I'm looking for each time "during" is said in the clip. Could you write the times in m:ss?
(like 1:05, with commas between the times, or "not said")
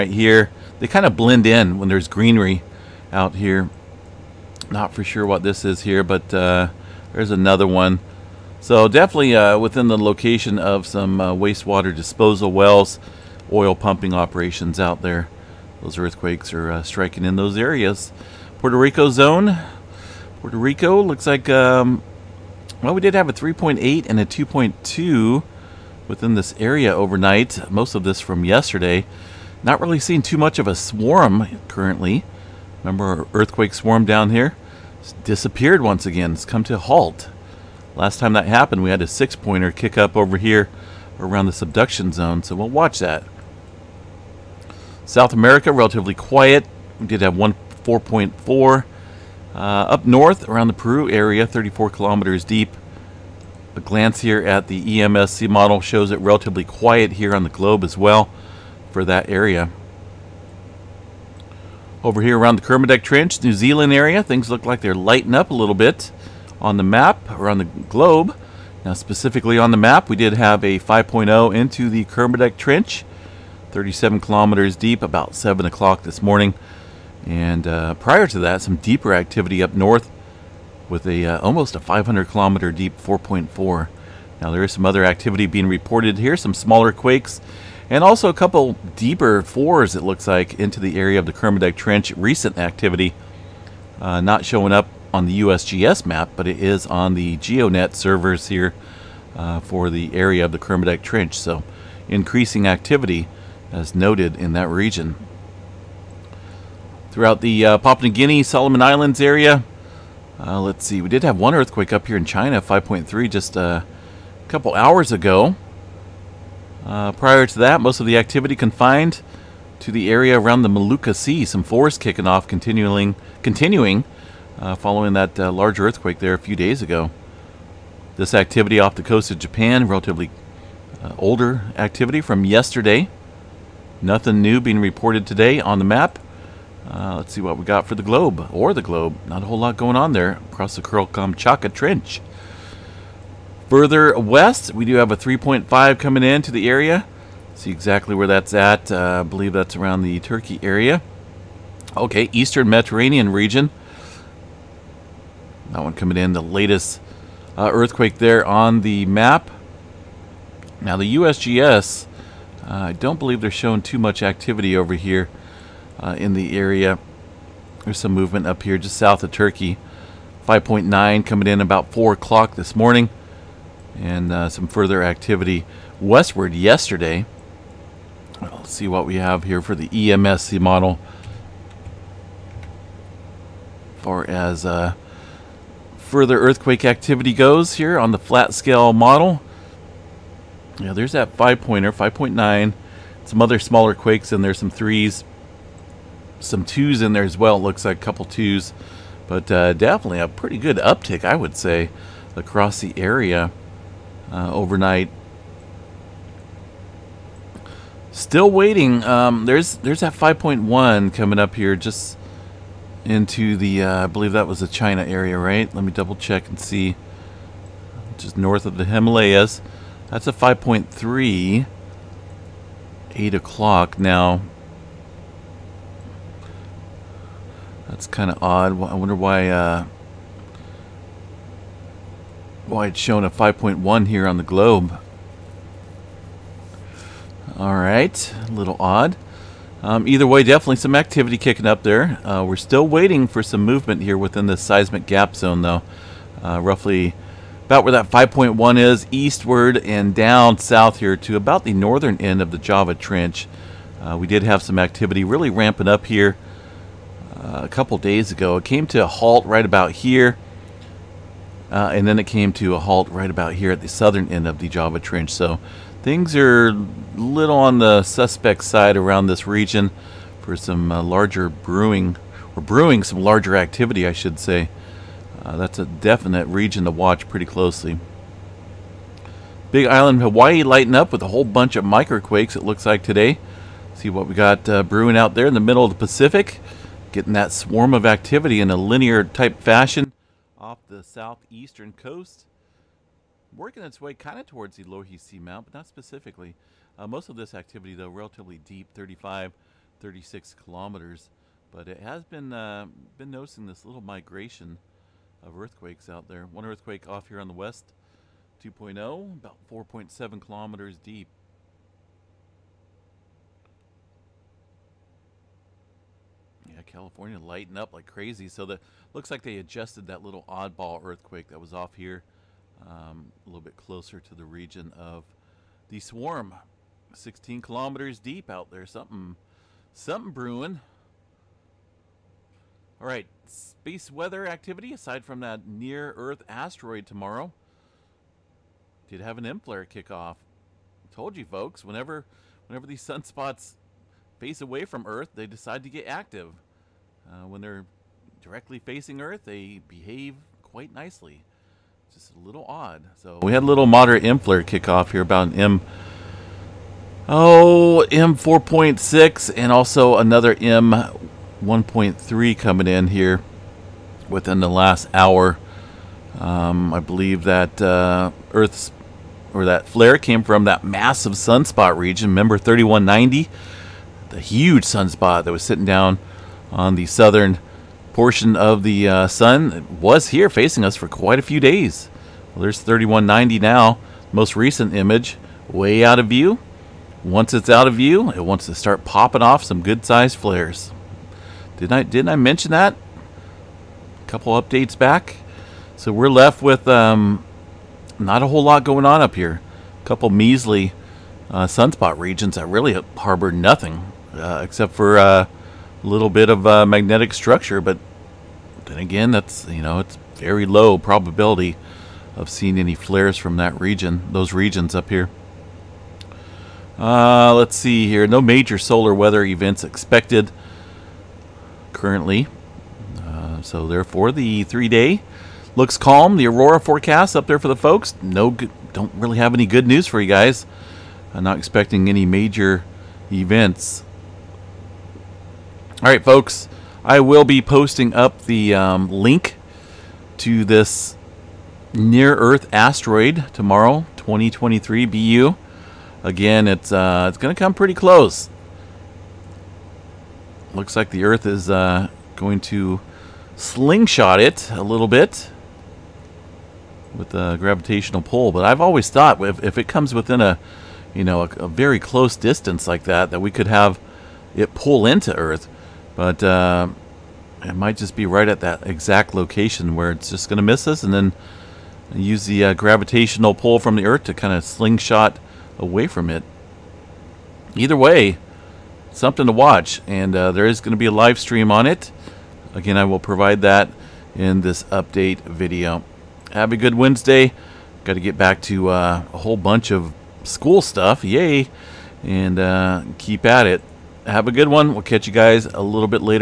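not said.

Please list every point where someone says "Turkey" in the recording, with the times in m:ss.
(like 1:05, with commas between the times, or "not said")
2:30, 2:49.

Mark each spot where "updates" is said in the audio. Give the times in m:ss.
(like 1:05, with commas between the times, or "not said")
6:34, 8:04.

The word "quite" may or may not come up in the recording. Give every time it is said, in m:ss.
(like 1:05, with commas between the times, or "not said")
5:50, 6:21.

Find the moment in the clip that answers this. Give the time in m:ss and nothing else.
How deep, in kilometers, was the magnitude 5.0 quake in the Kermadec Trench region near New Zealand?
1:13.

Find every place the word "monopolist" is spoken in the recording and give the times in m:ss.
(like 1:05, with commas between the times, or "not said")
not said.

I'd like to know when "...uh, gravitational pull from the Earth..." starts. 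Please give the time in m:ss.
7:52.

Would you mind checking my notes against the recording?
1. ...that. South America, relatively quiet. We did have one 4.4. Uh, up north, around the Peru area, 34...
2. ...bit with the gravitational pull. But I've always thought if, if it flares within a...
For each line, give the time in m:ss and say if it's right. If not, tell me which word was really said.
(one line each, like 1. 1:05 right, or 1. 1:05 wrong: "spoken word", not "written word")
1. 0:42 right
2. 7:35 wrong: "comes", not "flares".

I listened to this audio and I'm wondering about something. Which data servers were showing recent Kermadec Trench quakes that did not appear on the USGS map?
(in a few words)
GeoNet.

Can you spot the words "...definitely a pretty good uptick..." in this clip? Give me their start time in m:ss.
3:19.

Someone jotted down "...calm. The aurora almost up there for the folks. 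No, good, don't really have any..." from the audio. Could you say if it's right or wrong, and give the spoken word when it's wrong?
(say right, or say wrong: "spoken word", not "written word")
wrong: "forecast", not "almost".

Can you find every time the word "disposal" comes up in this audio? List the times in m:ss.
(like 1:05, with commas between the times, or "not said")
0:11.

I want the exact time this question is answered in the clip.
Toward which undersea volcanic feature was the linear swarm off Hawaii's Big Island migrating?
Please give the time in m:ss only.
4:54.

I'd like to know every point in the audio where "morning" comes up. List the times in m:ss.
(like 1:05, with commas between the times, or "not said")
1:16, 2:52.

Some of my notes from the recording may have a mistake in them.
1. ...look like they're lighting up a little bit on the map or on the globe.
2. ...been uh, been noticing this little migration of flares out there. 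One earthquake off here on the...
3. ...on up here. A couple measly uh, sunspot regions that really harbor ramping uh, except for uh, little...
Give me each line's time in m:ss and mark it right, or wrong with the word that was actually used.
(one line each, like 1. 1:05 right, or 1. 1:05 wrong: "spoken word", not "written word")
1. 1:04 right
2. 5:02 wrong: "earthquakes", not "flares"
3. 6:39 wrong: "nothing", not "ramping".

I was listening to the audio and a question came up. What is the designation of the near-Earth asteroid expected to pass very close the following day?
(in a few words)
2023 BU.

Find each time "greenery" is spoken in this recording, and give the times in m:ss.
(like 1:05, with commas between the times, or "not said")
0:02.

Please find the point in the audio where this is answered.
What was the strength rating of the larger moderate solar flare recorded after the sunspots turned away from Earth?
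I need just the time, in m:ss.
5:58.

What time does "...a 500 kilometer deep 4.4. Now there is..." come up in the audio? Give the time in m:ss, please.
1:21.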